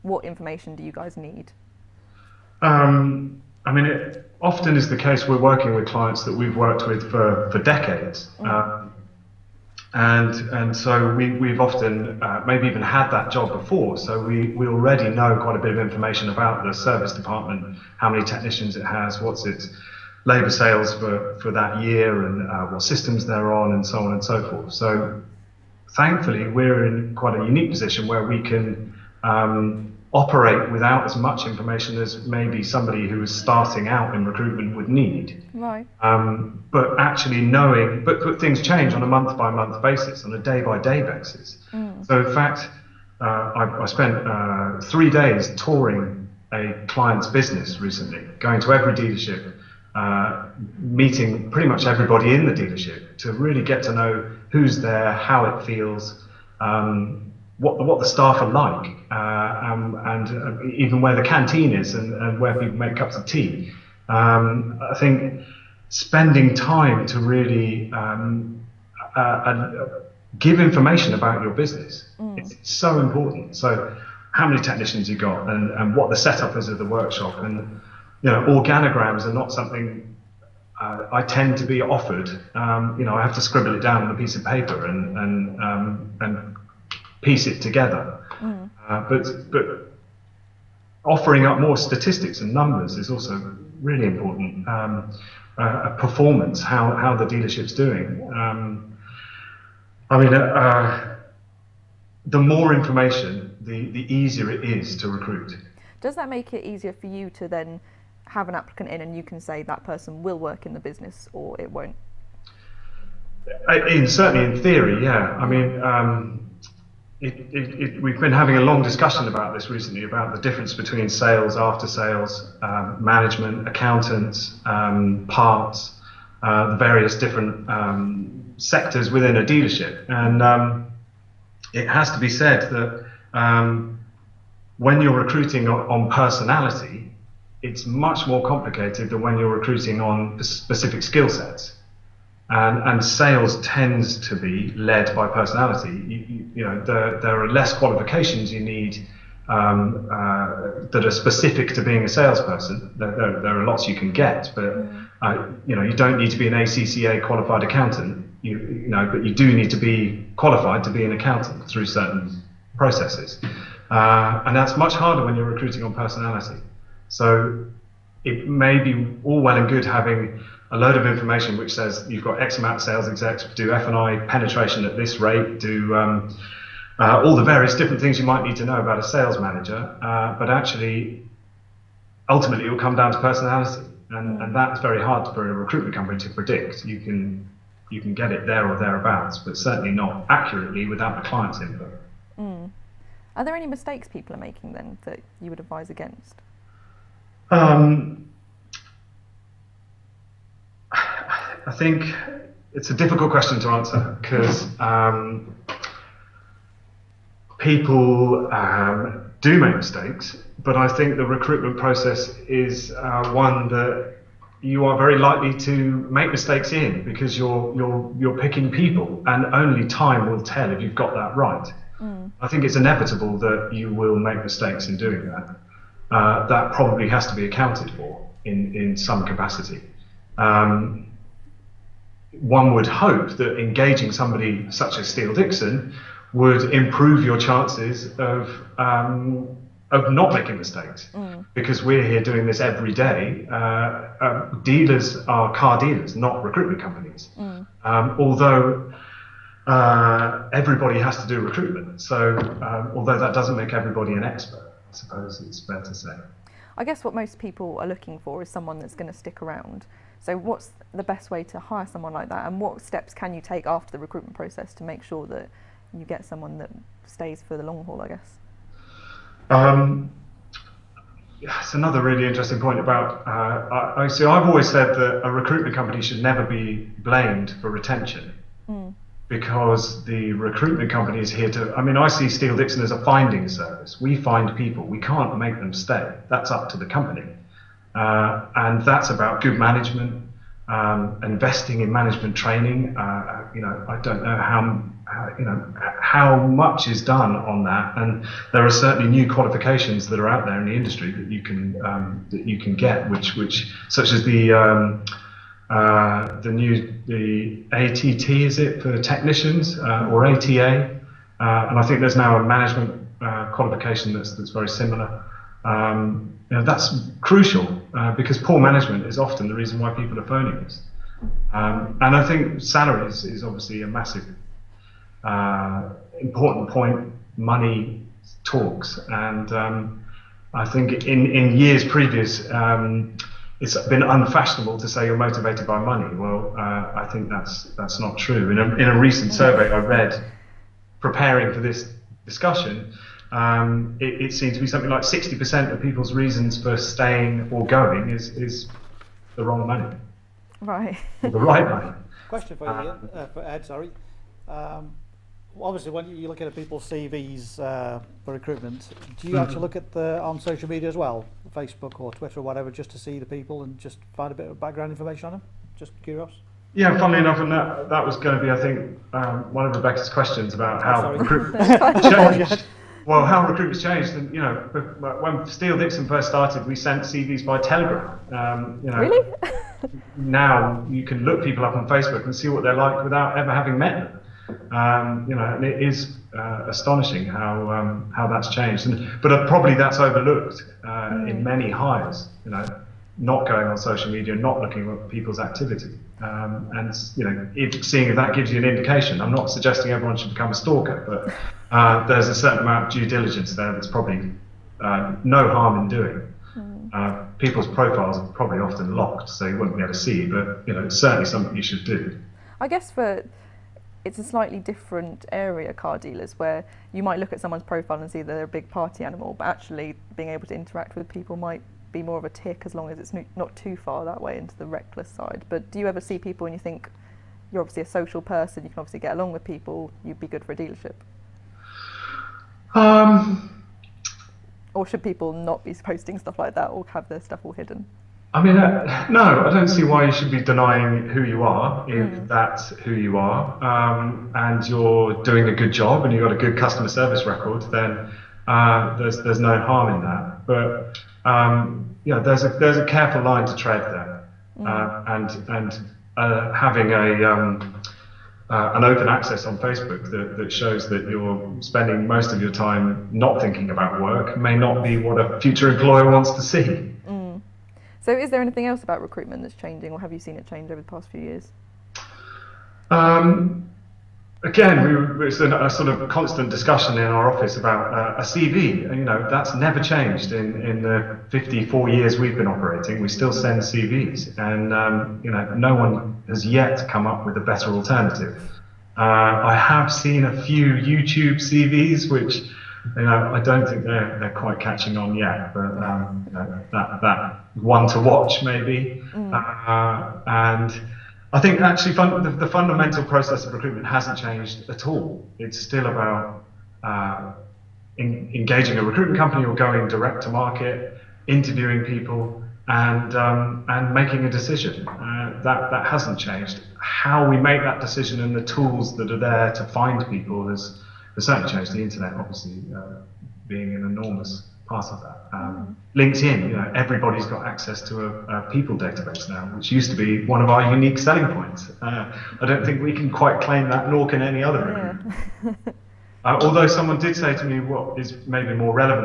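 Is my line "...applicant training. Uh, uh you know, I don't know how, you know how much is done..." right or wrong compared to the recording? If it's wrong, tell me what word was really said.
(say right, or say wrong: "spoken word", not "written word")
wrong: "management", not "applicant".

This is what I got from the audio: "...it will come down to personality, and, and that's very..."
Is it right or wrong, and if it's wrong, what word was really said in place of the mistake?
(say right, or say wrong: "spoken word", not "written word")
right.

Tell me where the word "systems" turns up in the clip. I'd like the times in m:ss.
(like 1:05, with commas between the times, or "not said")
0:22.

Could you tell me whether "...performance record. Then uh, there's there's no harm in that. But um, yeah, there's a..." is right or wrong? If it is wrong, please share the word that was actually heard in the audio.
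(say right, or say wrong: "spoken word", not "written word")
wrong: "service", not "performance".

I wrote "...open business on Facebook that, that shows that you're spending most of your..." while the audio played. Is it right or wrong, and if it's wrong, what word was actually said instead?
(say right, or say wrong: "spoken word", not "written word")
wrong: "access", not "business".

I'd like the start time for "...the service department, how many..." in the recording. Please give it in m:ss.
0:16.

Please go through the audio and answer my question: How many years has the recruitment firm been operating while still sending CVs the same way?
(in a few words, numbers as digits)
54.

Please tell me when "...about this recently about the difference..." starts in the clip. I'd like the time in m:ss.
1:59.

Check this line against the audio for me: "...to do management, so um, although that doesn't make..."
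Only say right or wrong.
wrong.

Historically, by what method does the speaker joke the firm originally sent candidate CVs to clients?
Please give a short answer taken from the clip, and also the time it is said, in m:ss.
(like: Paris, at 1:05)
telegram, at 6:17.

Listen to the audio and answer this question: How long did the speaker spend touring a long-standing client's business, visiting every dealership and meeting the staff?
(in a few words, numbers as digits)
3 days.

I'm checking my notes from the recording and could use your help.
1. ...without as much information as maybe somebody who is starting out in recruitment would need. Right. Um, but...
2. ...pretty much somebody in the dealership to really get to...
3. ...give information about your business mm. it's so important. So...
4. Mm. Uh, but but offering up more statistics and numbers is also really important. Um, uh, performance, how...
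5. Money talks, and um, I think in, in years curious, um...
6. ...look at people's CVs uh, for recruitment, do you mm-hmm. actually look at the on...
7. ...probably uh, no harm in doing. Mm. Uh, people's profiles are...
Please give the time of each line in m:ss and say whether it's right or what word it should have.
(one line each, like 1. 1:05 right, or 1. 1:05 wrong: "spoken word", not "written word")
1. 0:30 right
2. 0:51 wrong: "everybody", not "somebody"
3. 1:10 right
4. 1:28 right
5. 5:27 wrong: "previous", not "curious"
6. 5:56 right
7. 6:43 right.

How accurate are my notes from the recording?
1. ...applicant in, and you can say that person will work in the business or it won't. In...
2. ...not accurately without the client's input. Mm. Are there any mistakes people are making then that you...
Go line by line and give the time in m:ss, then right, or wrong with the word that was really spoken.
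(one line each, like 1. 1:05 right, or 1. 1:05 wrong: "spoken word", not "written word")
1. 1:48 right
2. 3:09 right.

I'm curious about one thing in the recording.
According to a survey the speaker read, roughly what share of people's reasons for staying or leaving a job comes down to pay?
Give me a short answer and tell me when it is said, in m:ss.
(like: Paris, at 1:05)
60%, at 5:45.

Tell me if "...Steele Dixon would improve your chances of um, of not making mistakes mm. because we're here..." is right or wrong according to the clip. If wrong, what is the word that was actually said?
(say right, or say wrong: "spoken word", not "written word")
right.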